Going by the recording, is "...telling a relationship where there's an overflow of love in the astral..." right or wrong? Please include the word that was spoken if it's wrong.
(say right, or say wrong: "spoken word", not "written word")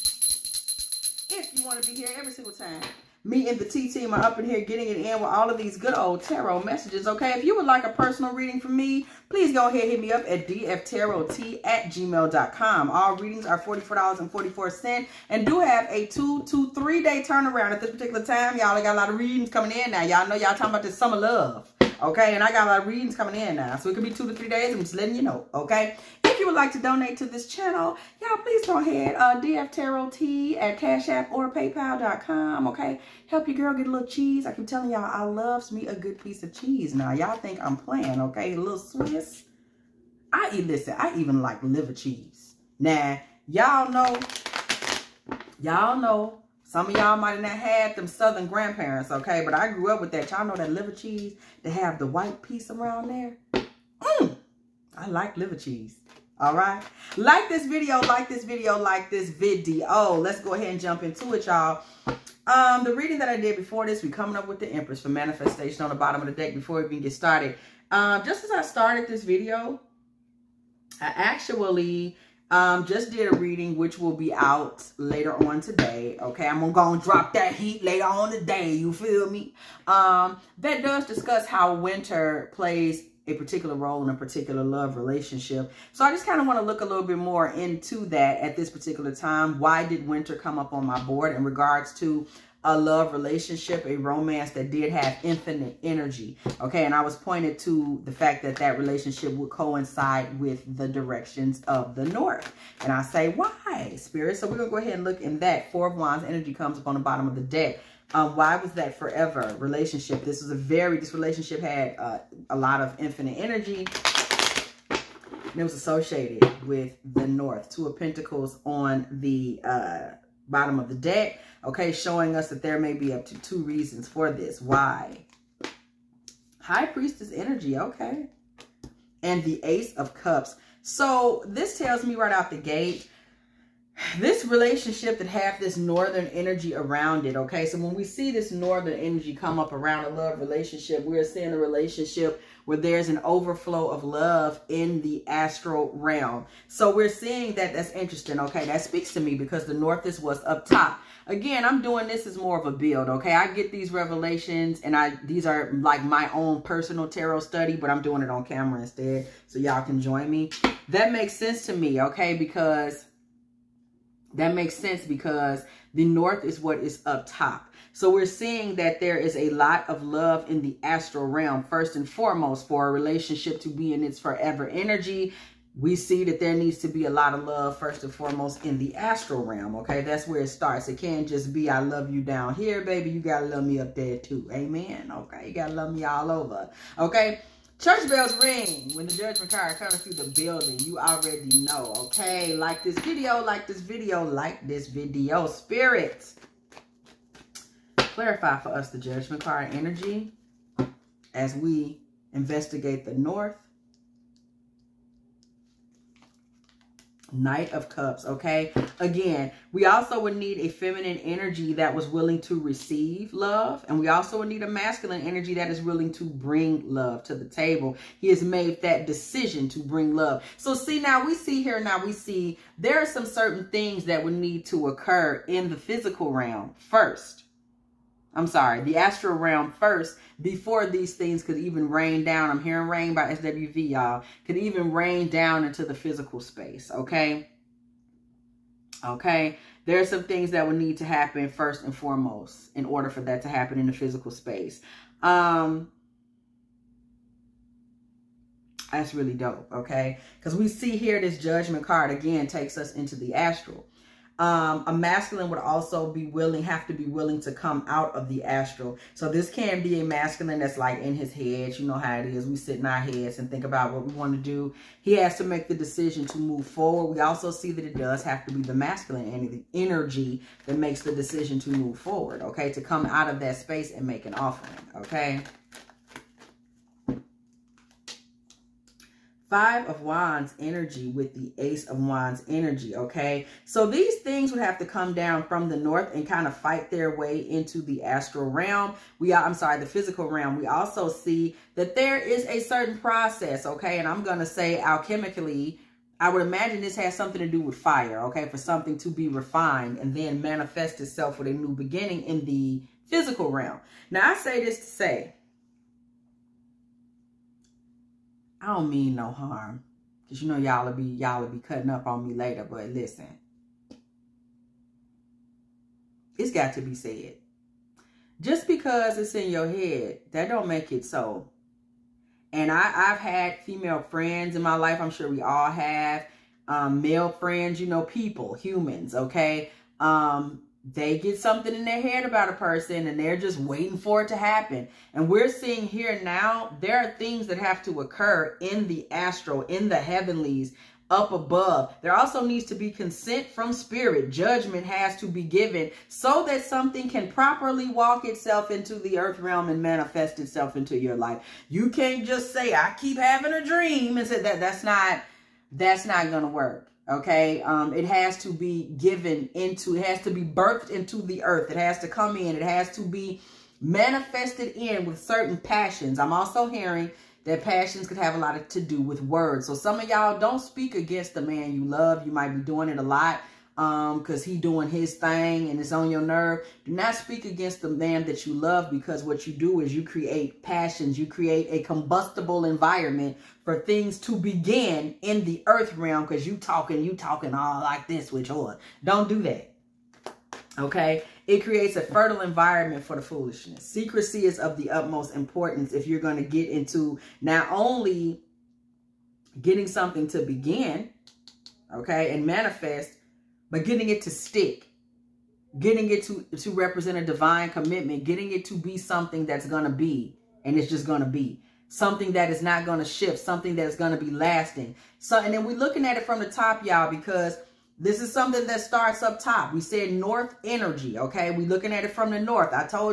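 wrong: "seeing", not "telling".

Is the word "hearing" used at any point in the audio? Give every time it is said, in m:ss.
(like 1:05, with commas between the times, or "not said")
3:52, 6:06.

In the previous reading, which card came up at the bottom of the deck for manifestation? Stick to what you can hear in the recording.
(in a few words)
the Empress.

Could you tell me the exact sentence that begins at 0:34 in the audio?
I keep telling y'all, I loves me a good piece of cheese.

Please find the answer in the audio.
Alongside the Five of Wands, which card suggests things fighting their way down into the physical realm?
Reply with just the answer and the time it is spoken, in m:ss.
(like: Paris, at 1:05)
Ace of Wands, at 4:41.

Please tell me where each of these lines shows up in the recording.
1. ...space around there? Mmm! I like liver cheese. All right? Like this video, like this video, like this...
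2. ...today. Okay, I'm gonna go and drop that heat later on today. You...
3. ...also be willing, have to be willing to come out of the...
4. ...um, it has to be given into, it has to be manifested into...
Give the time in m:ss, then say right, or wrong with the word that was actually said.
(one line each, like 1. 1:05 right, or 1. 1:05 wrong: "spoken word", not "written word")
1. 0:52 wrong: "piece", not "space"
2. 1:15 right
3. 4:15 right
4. 5:57 wrong: "birthed", not "manifested".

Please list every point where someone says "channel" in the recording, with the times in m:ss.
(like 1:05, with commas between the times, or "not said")
0:27.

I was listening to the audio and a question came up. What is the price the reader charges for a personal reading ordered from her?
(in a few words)
$44.44.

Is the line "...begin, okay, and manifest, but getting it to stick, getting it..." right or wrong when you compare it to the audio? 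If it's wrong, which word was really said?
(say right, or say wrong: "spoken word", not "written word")
right.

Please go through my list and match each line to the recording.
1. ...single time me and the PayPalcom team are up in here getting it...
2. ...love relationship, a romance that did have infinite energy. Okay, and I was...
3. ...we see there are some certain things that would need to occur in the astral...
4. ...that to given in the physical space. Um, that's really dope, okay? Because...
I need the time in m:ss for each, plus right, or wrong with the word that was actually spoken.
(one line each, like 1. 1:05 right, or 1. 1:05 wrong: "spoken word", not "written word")
1. 0:02 wrong: "Tea", not "PayPalcom"
2. 1:32 right
3. 3:42 wrong: "physical", not "astral"
4. 4:03 wrong: "happen", not "given".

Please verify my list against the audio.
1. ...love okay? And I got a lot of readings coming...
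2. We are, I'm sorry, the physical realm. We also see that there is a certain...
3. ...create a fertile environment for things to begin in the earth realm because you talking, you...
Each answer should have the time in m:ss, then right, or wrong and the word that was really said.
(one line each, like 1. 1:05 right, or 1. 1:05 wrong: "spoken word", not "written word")
1. 0:21 right
2. 4:49 right
3. 6:21 wrong: "combustible", not "fertile".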